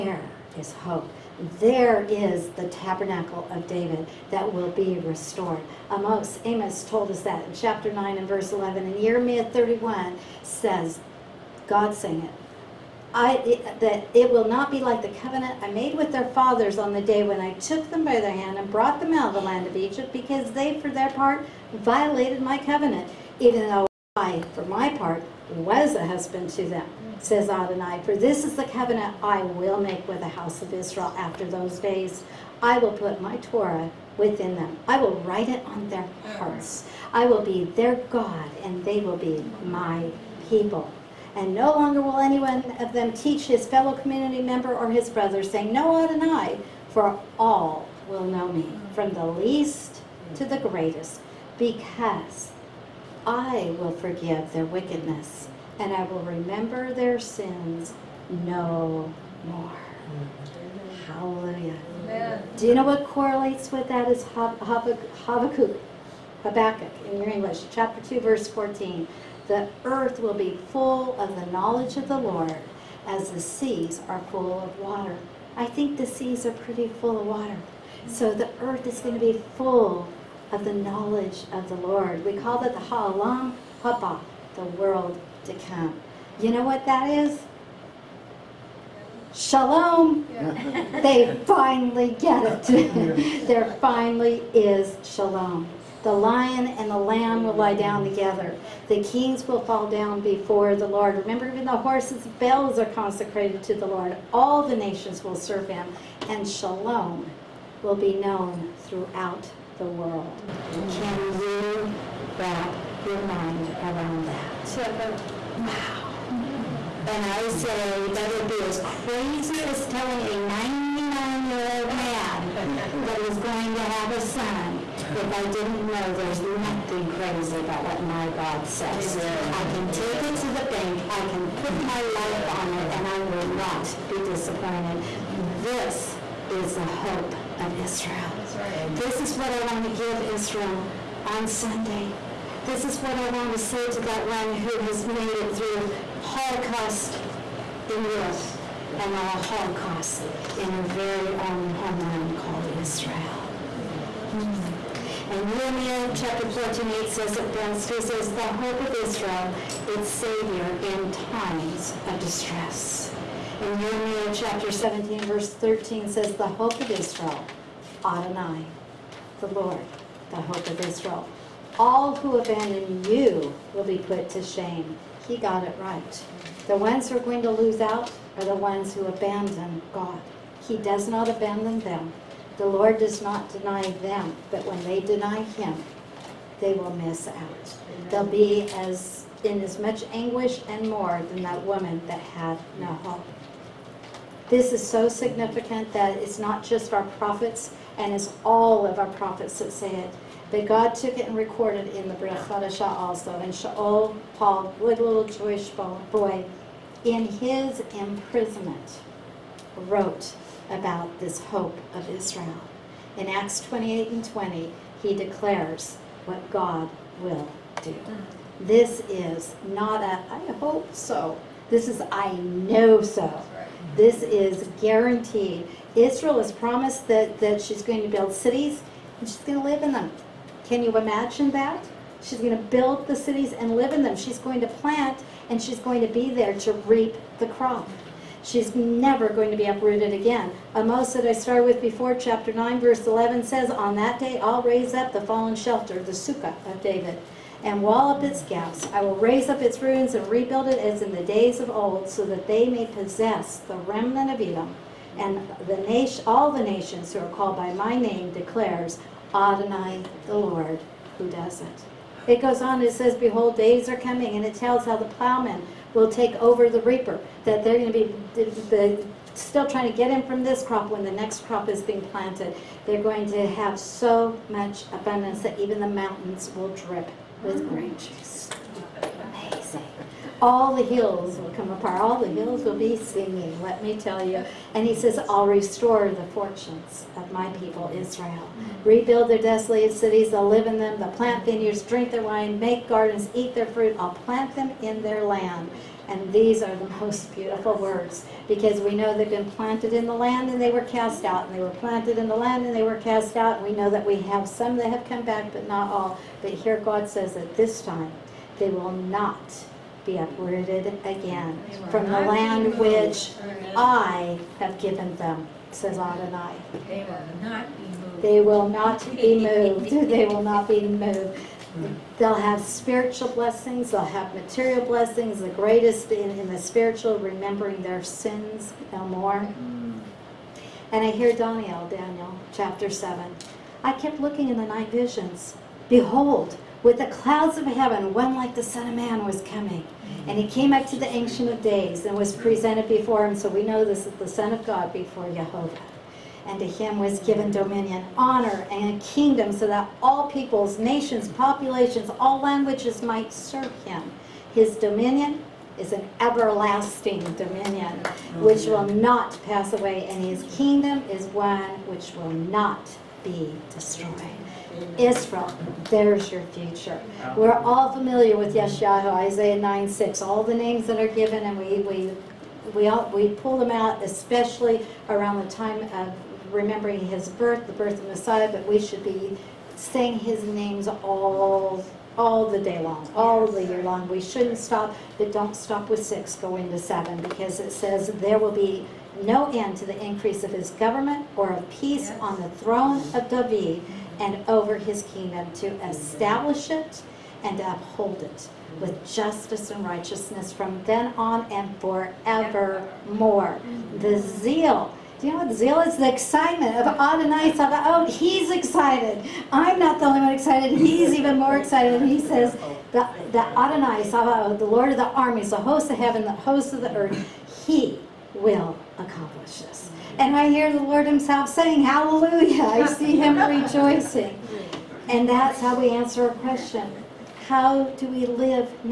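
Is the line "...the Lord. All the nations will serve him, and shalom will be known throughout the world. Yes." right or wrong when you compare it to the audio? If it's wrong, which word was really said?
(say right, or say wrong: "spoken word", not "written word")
right.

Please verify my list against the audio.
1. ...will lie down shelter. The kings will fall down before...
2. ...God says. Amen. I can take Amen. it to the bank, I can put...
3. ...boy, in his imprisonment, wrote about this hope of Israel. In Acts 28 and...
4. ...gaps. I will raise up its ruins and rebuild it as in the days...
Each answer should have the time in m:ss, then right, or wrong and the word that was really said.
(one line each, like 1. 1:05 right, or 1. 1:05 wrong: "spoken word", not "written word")
1. 1:37 wrong: "together", not "shelter"
2. 2:08 right
3. 3:25 right
4. 4:08 right.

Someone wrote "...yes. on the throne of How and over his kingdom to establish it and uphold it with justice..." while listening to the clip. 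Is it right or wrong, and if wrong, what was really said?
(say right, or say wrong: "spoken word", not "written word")
wrong: "David", not "How".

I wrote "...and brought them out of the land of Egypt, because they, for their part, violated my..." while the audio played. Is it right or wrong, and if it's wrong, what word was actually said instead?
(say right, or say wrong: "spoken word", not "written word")
right.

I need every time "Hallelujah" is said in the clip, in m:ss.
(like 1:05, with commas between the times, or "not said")
1:01, 7:01.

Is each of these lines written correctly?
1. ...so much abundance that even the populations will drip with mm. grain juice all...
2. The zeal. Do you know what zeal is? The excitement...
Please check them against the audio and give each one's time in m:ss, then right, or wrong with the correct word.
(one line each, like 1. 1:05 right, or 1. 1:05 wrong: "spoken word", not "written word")
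1. 4:33 wrong: "mountains", not "populations"
2. 6:43 right.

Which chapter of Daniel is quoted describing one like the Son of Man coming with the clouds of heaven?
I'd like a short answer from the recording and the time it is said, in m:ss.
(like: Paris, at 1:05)
Chapter 7, at 5:31.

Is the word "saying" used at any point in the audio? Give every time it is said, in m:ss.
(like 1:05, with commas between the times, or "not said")
0:11, 0:45, 6:19, 7:01.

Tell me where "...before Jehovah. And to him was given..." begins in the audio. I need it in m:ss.
5:44.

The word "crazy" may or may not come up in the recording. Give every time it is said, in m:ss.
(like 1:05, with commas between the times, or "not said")
1:59, 2:07.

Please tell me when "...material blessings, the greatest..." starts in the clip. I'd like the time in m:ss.
5:24.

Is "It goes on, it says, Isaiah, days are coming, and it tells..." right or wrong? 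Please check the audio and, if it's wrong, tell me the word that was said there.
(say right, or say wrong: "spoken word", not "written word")
wrong: "Behold", not "Isaiah".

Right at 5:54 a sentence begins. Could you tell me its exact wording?
His dominion is an everlasting dominion which will not pass away, and his kingdom is one which will not be destroyed.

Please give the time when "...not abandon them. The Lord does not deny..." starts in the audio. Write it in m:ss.
3:01.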